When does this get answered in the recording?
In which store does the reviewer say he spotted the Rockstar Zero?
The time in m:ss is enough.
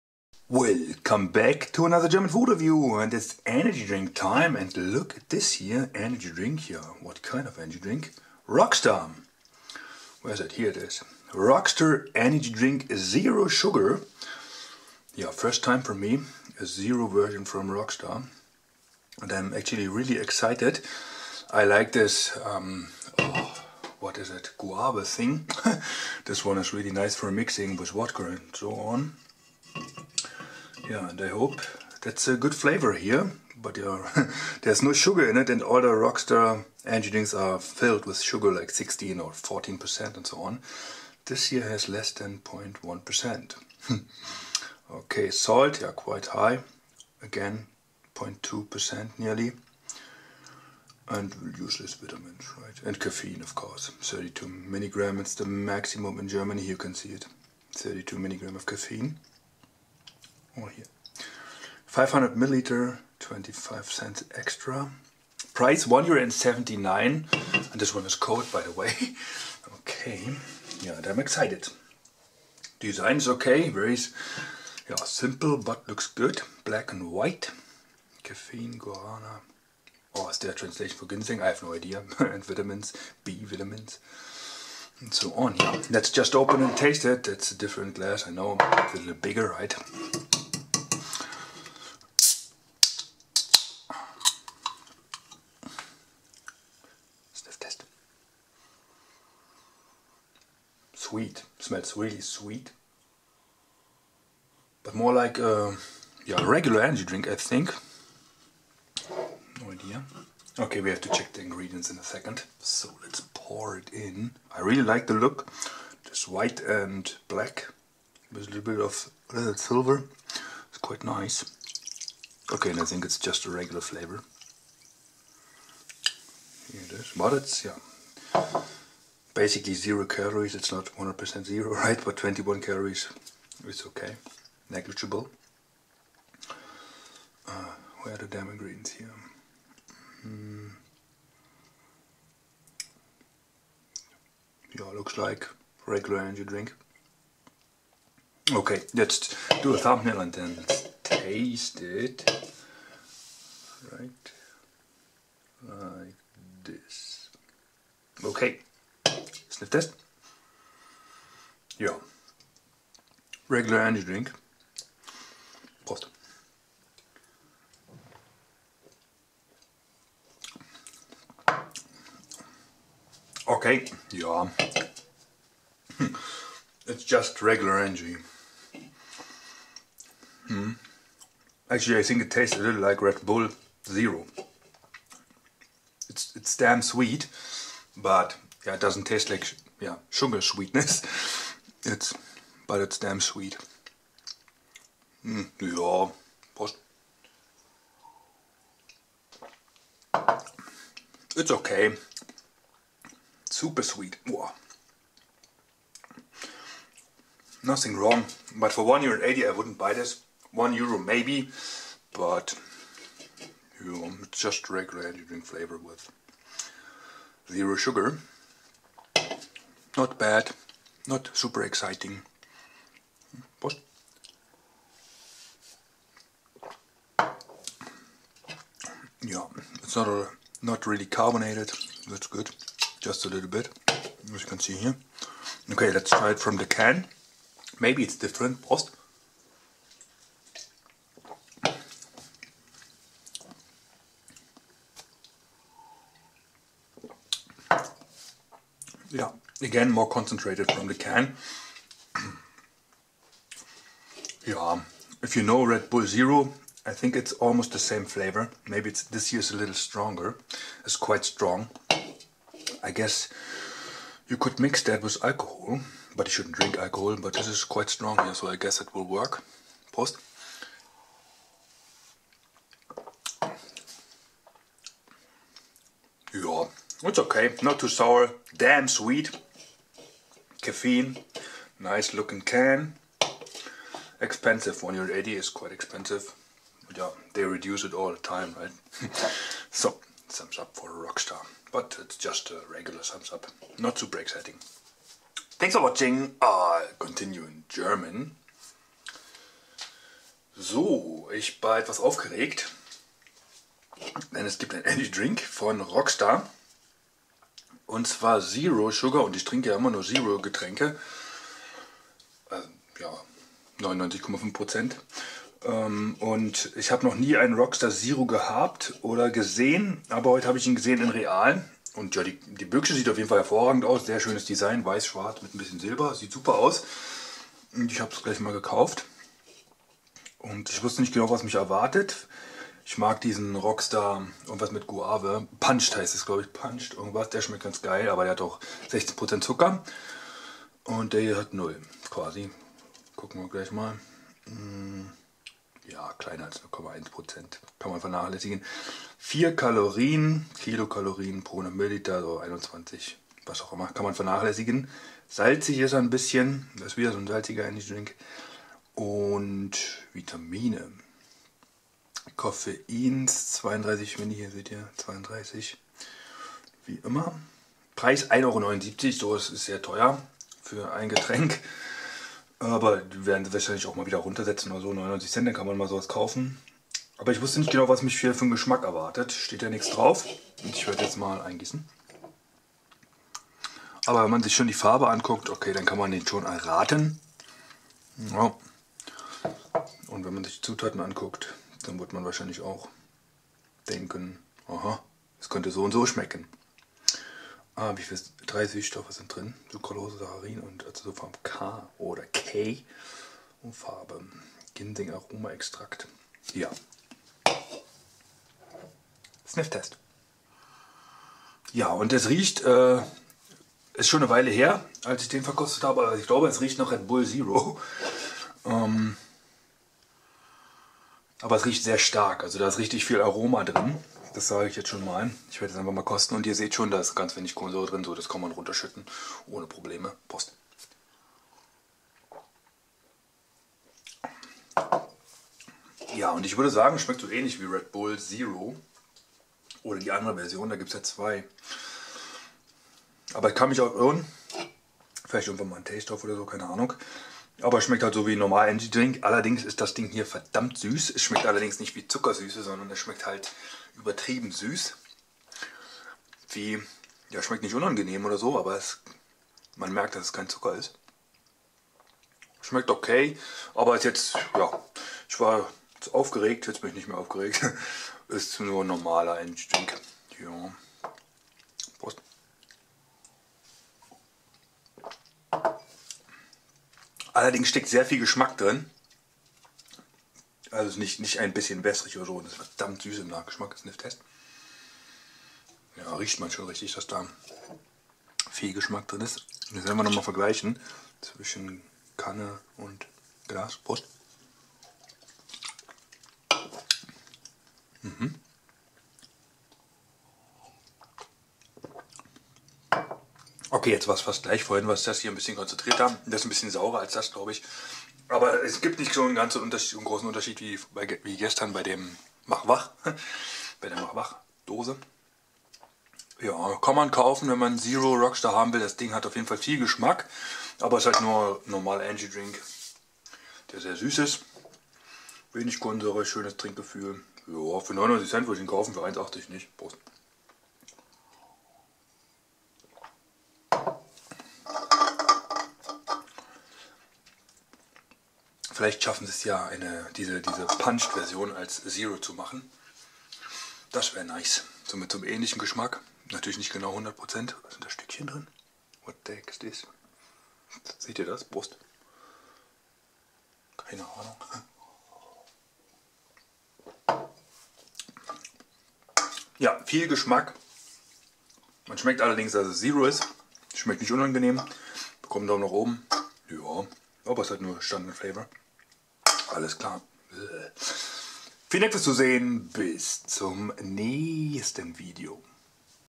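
5:21.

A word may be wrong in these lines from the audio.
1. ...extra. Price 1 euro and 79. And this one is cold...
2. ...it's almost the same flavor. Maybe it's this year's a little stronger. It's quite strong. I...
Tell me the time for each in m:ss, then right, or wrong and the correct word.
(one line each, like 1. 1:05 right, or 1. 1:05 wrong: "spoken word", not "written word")
1. 1:04 right
2. 4:17 right.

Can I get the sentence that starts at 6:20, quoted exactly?
Und ich werde jetzt mal eingießen.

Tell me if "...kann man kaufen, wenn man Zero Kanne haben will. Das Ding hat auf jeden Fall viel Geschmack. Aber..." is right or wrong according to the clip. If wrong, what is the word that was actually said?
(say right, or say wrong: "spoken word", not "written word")
wrong: "Rockstar", not "Kanne".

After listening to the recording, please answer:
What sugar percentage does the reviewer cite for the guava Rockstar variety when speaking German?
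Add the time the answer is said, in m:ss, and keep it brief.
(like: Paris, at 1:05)
16%, at 5:38.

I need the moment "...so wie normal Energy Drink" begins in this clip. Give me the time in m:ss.
7:28.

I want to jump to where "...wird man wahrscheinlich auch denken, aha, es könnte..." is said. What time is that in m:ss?
6:31.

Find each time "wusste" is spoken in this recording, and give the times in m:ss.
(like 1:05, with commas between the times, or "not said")
5:30, 6:17.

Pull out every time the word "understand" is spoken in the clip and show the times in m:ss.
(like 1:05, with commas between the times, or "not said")
not said.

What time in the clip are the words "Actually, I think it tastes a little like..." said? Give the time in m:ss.
3:01.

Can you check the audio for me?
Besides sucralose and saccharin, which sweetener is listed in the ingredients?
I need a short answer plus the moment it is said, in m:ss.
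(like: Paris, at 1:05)
Acesulfam K, at 6:40.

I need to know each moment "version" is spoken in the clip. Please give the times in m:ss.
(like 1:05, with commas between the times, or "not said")
0:17, 7:20, 9:00.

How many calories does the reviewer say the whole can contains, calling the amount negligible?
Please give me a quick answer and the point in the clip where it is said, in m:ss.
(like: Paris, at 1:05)
21, at 2:12.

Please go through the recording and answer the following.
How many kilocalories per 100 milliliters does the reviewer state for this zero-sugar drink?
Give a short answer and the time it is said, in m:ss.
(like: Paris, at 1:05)
4, at 5:49.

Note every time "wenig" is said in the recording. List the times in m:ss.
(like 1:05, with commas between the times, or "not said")
7:07, 8:45.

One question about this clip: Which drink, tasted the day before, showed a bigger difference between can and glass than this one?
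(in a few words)
Machwach.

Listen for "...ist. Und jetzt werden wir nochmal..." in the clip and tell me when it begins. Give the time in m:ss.
8:09.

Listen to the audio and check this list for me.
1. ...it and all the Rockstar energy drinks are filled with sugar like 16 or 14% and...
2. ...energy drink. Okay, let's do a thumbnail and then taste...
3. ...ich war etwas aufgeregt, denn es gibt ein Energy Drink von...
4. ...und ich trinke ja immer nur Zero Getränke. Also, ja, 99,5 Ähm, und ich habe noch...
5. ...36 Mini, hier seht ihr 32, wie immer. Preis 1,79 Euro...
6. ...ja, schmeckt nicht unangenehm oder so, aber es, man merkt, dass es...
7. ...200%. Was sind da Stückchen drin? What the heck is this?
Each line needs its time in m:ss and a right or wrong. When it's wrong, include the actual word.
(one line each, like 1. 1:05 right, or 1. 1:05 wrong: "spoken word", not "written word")
1. 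0:35 right
2. 2:26 right
3. 5:01 right
4. 5:09 right
5. 6:03 wrong: "32", not "36"
6. 7:37 right
7. 9:06 wrong: "100", not "200".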